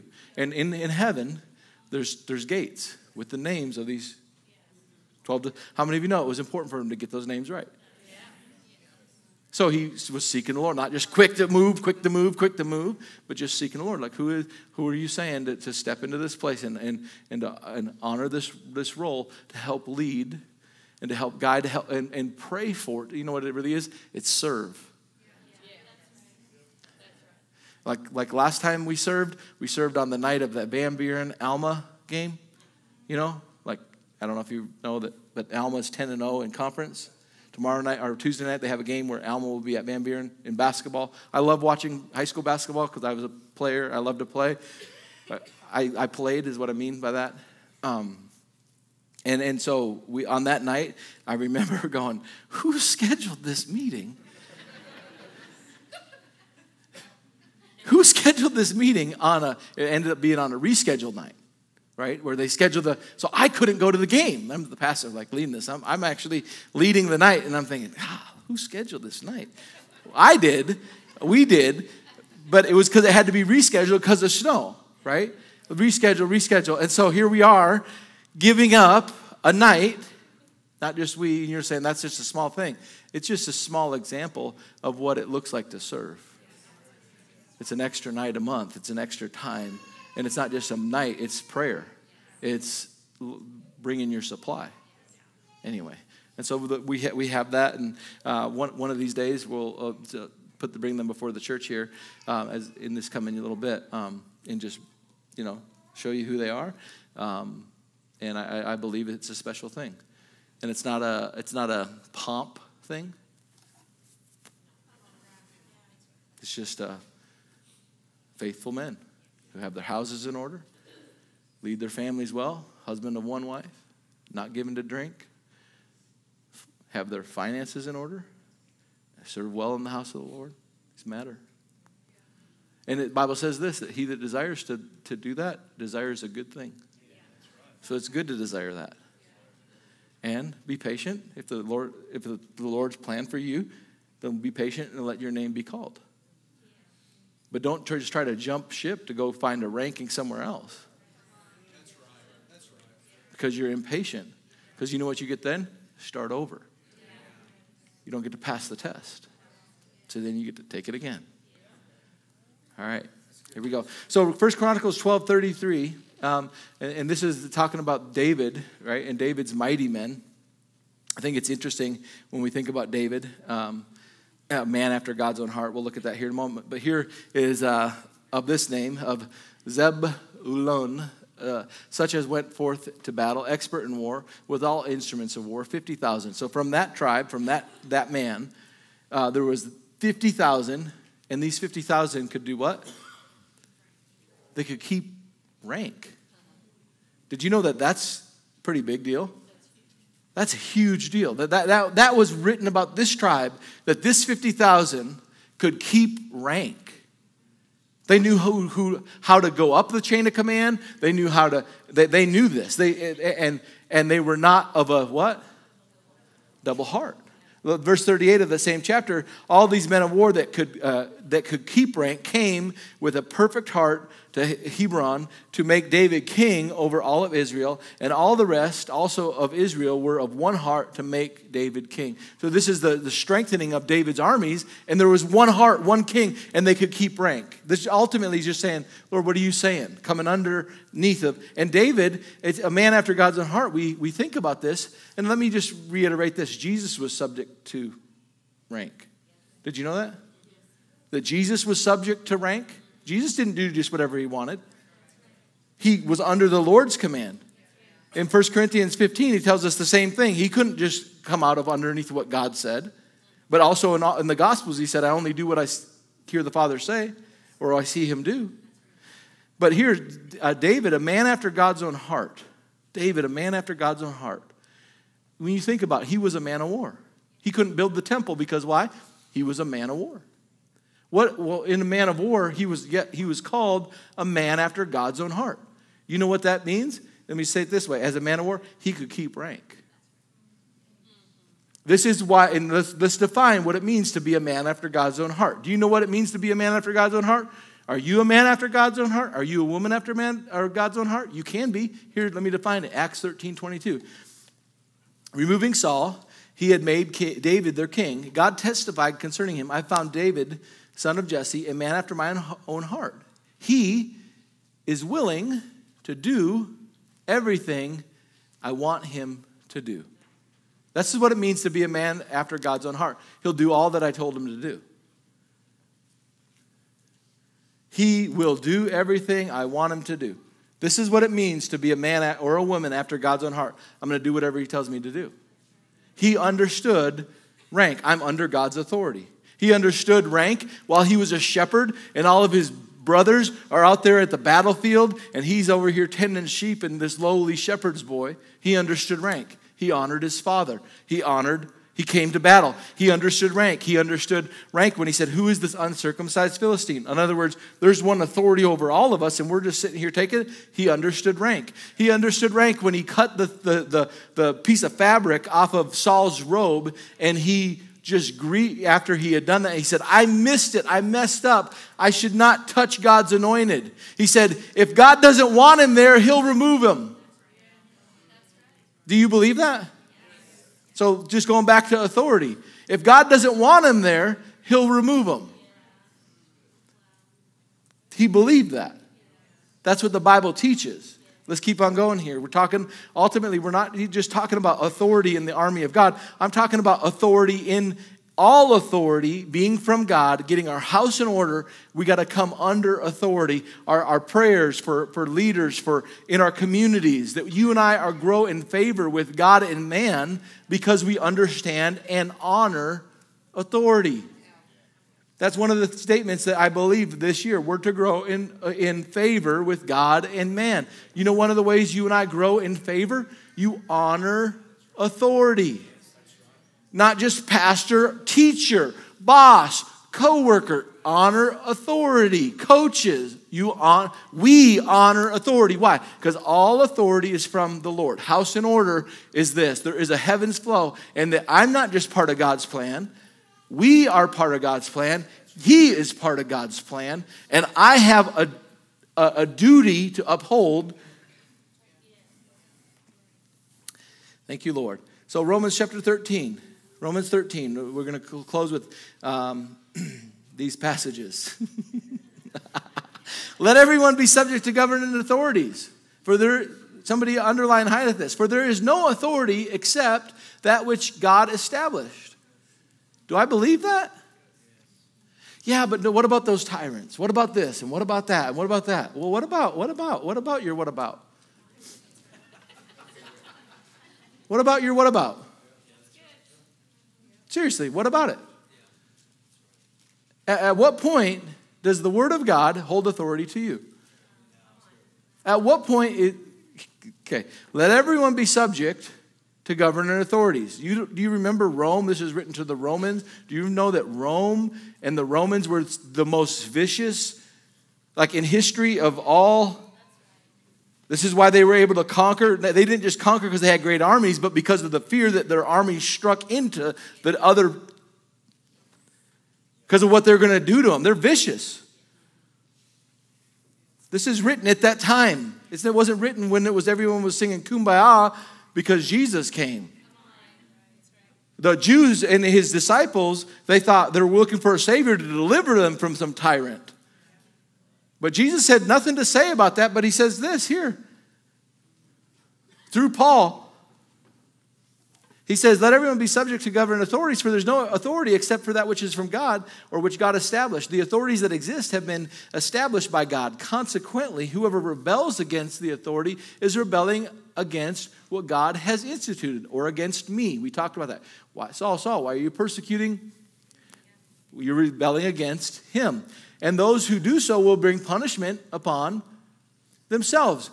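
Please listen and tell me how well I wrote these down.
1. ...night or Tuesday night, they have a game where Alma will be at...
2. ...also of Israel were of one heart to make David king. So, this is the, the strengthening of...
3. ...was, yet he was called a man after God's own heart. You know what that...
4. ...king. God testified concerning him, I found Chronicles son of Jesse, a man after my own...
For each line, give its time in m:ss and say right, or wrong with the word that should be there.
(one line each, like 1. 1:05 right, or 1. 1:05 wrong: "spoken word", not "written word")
1. 0:37 right
2. 3:48 right
3. 4:42 right
4. 5:07 wrong: "David", not "Chronicles".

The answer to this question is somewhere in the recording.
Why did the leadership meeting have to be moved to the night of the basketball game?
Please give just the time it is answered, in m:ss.
1:14.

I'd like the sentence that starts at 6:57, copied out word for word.
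We're to grow in, uh, in favor with God and man.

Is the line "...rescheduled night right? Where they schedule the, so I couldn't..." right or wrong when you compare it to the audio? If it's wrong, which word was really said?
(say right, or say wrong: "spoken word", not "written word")
right.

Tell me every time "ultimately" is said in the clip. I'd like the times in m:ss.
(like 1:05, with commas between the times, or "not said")
3:57, 6:33.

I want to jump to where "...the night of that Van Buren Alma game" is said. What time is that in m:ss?
0:30.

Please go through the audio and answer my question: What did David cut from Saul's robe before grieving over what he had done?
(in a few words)
piece of fabric.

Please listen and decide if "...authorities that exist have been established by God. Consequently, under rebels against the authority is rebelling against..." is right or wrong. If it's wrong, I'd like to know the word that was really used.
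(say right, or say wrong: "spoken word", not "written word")
wrong: "whoever", not "under".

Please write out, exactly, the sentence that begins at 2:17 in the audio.
So it's good to desire that.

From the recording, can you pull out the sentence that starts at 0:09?
So he was seeking the Lord, not just quick to move, quick to move, quick to move, but just seeking the Lord.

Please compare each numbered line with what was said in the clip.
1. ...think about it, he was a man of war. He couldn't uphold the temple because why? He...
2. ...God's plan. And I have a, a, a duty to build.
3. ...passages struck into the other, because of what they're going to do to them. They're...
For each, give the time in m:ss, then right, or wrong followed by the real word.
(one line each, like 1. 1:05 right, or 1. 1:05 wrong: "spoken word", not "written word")
1. 4:35 wrong: "build", not "uphold"
2. 7:26 wrong: "uphold", not "build"
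3. 8:35 wrong: "armies", not "passages".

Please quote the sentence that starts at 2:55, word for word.
We'll look at that here in a moment.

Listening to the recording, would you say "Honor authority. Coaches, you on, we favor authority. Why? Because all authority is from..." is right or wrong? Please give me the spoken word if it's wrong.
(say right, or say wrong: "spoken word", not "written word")
wrong: "honor", not "favor".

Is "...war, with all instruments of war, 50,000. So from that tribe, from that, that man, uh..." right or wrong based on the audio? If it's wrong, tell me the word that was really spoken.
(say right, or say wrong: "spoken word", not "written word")
right.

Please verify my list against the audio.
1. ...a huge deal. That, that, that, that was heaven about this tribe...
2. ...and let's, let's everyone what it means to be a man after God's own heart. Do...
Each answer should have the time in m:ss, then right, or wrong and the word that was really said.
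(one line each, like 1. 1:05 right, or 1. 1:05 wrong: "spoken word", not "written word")
1. 3:20 wrong: "written", not "heaven"
2. 4:52 wrong: "define", not "everyone".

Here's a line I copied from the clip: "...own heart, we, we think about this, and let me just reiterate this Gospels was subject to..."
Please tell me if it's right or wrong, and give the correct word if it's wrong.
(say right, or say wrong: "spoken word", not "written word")
wrong: "Jesus", not "Gospels".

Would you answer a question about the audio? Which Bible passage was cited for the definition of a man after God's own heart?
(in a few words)
Acts 13.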